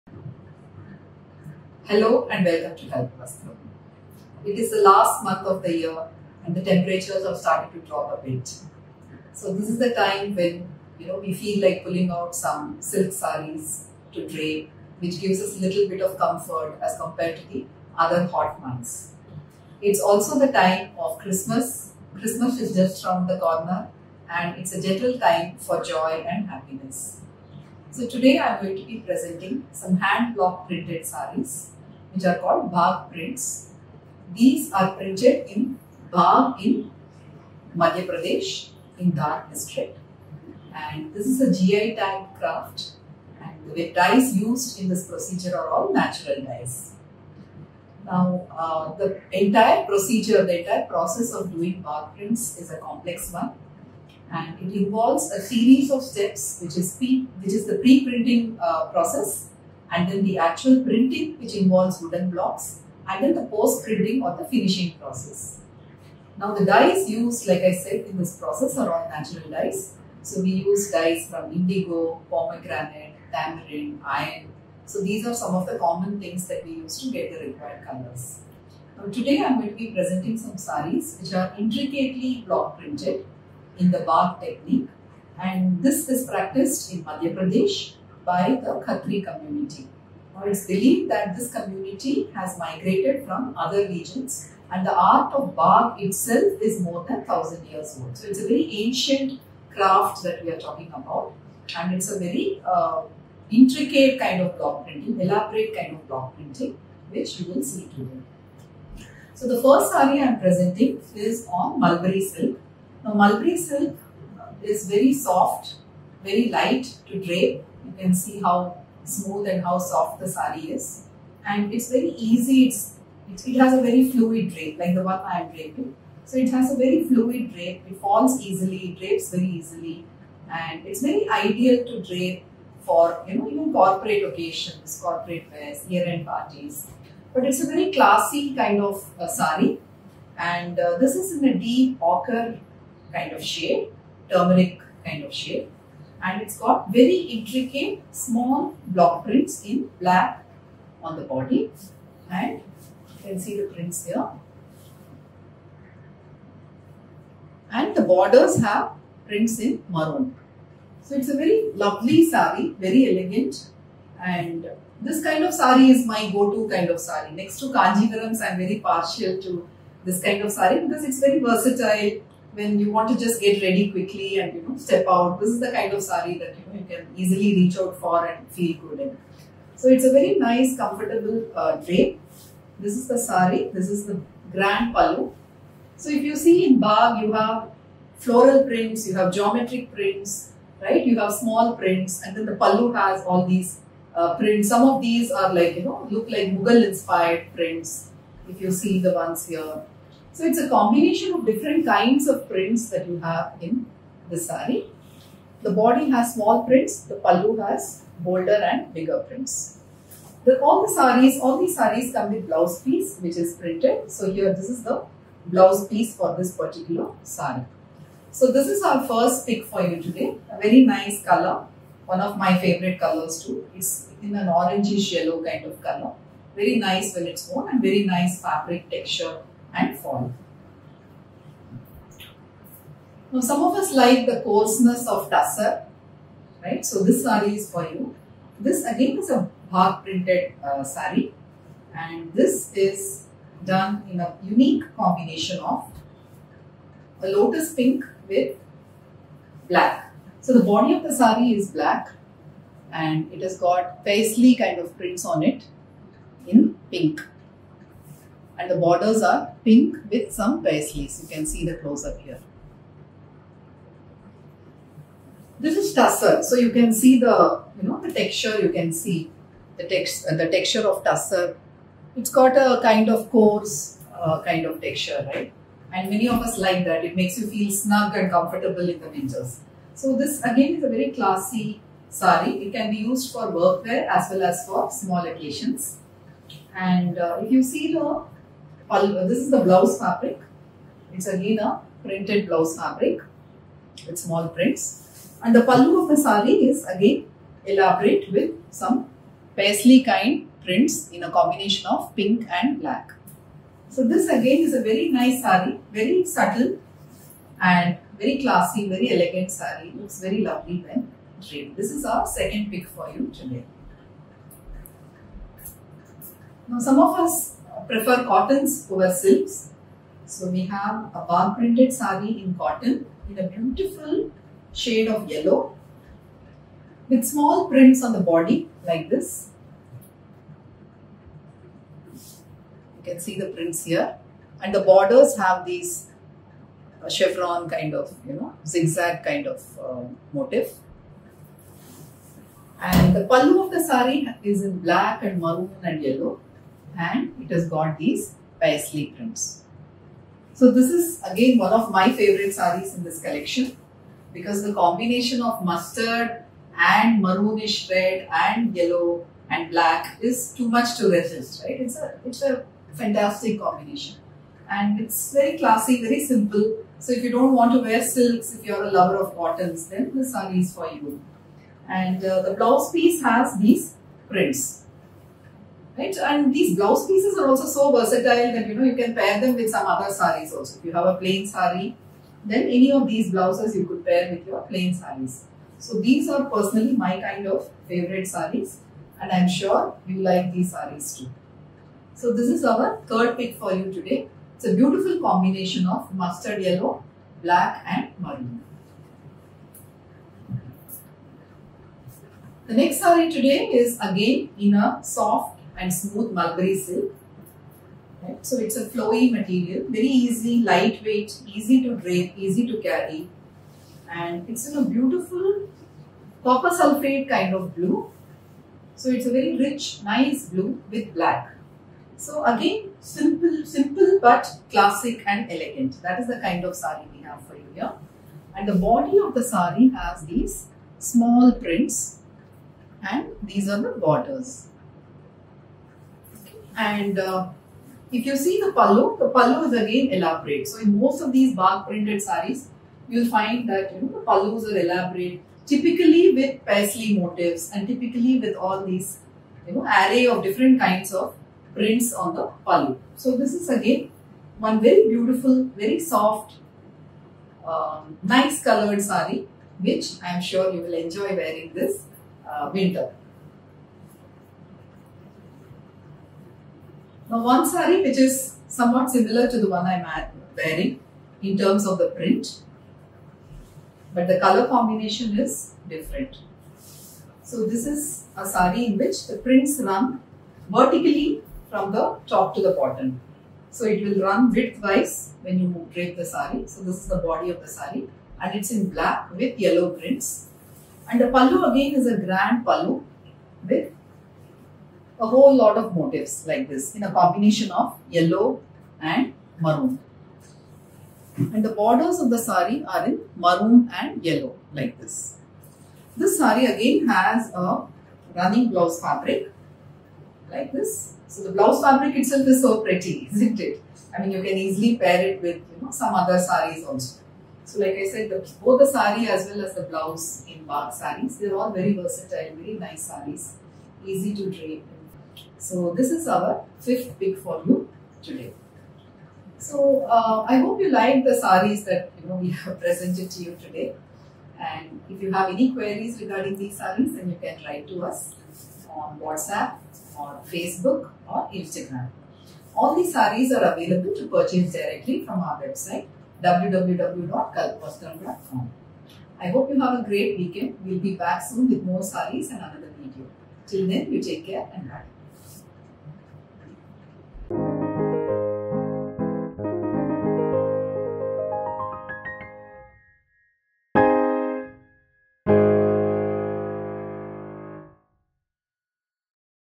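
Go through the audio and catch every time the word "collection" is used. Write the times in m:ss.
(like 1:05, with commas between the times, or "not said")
5:53.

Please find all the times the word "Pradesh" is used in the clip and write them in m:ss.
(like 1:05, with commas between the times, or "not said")
0:38, 1:27.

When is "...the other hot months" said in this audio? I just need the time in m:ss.
0:17.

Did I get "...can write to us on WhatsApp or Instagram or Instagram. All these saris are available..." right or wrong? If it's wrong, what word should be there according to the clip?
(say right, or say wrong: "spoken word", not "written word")
wrong: "Facebook", not "Instagram".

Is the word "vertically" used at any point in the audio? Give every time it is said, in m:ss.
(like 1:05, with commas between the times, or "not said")
8:00.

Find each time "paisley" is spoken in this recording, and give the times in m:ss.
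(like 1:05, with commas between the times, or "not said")
4:14, 4:20, 4:59, 5:48, 7:26.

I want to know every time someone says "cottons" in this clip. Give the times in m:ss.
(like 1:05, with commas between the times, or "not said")
5:18, 5:22, 6:09.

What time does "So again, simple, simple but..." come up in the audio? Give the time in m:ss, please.
7:02.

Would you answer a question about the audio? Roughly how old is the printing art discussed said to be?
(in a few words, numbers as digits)
More than 1000 years.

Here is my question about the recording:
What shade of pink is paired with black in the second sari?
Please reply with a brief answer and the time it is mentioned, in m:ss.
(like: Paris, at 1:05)
Lotus pink, at 4:07.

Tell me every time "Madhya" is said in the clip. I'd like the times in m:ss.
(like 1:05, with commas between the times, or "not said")
0:37, 1:27.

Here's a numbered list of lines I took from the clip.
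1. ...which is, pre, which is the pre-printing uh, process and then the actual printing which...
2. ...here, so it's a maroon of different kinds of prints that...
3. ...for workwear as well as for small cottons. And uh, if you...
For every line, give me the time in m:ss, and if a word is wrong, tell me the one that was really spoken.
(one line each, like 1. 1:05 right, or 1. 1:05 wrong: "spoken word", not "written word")
1. 0:56 right
2. 3:19 wrong: "combination", not "maroon"
3. 4:43 wrong: "occasions", not "cottons".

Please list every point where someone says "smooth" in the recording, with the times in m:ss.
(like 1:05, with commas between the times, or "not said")
1:59, 6:45.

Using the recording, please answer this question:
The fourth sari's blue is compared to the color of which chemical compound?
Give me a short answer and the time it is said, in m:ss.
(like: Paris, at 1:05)
Copper sulfate, at 6:56.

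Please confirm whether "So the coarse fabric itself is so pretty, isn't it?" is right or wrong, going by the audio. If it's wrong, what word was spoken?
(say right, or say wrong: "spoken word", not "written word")
wrong: "blouse", not "coarse".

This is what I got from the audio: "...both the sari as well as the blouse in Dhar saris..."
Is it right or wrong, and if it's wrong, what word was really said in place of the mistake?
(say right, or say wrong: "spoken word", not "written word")
wrong: "Bagh", not "Dhar".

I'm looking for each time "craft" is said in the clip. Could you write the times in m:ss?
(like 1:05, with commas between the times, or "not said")
0:42, 1:39.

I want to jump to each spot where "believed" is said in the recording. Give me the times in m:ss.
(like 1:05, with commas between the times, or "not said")
1:30.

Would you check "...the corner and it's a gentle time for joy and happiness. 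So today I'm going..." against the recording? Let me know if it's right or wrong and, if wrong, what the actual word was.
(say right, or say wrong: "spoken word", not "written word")
right.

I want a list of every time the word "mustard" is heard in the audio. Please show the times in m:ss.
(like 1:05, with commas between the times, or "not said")
5:55, 6:36.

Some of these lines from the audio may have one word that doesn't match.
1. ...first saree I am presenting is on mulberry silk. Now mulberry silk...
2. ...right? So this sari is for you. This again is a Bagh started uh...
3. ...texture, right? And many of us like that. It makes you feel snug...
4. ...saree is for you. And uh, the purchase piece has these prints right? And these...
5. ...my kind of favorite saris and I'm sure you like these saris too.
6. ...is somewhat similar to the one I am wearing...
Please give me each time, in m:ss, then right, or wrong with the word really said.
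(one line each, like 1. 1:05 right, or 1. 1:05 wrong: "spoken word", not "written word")
1. 1:49 right
2. 3:56 wrong: "printed", not "started"
3. 4:34 right
4. 6:10 wrong: "blouse", not "purchase"
5. 6:26 right
6. 7:48 right.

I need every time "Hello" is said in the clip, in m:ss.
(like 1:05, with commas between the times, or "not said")
0:01.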